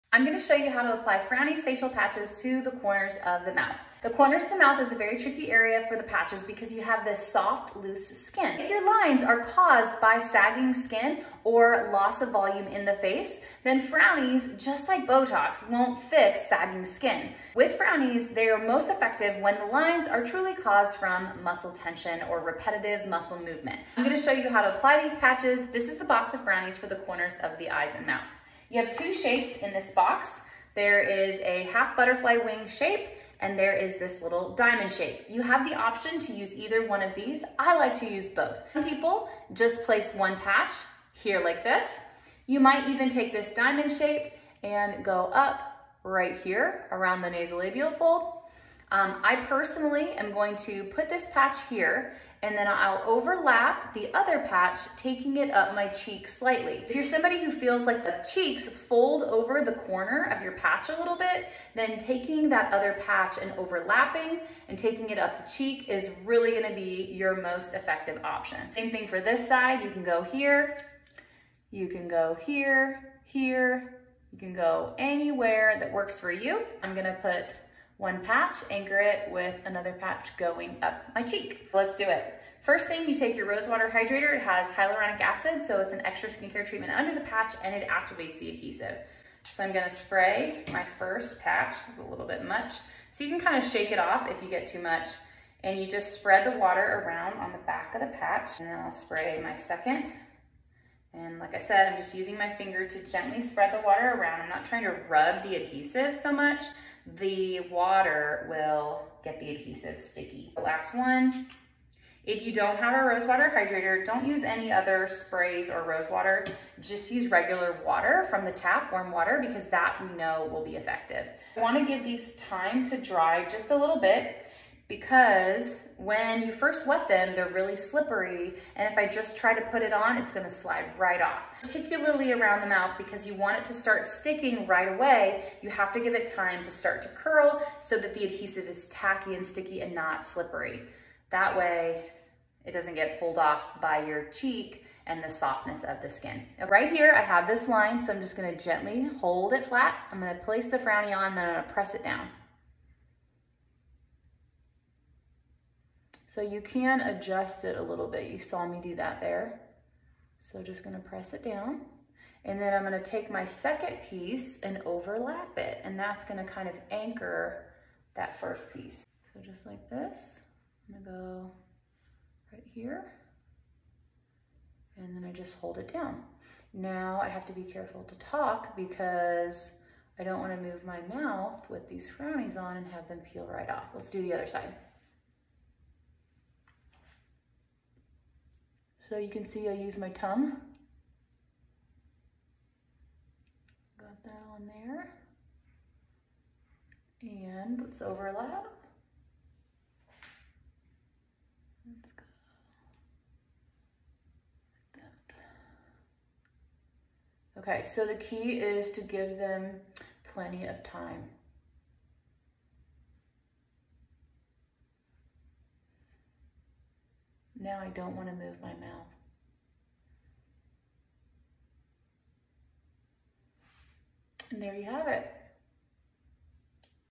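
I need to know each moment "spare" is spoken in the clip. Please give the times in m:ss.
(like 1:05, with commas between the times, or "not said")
not said.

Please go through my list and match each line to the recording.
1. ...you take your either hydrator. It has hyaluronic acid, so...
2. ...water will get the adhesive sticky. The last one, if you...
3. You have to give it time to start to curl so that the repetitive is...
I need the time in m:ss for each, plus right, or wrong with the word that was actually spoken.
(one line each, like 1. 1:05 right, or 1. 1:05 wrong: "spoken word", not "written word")
1. 1:23 wrong: "rosewater", not "either"
2. 1:47 right
3. 2:15 wrong: "adhesive", not "repetitive".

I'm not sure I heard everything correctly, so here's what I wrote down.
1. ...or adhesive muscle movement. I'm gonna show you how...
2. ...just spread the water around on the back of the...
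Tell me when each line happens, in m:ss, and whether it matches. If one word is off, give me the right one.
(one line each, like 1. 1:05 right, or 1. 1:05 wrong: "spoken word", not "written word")
1. 0:22 wrong: "repetitive", not "adhesive"
2. 1:35 right.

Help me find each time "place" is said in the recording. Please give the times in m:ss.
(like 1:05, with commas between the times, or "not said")
0:39, 2:30.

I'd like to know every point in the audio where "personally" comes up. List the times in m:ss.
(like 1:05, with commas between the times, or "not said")
0:49.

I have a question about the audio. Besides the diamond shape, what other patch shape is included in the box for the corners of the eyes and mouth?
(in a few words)
Half butterfly wing.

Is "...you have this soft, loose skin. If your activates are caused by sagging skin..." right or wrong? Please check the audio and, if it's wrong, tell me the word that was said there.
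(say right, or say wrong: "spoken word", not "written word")
wrong: "lines", not "activates".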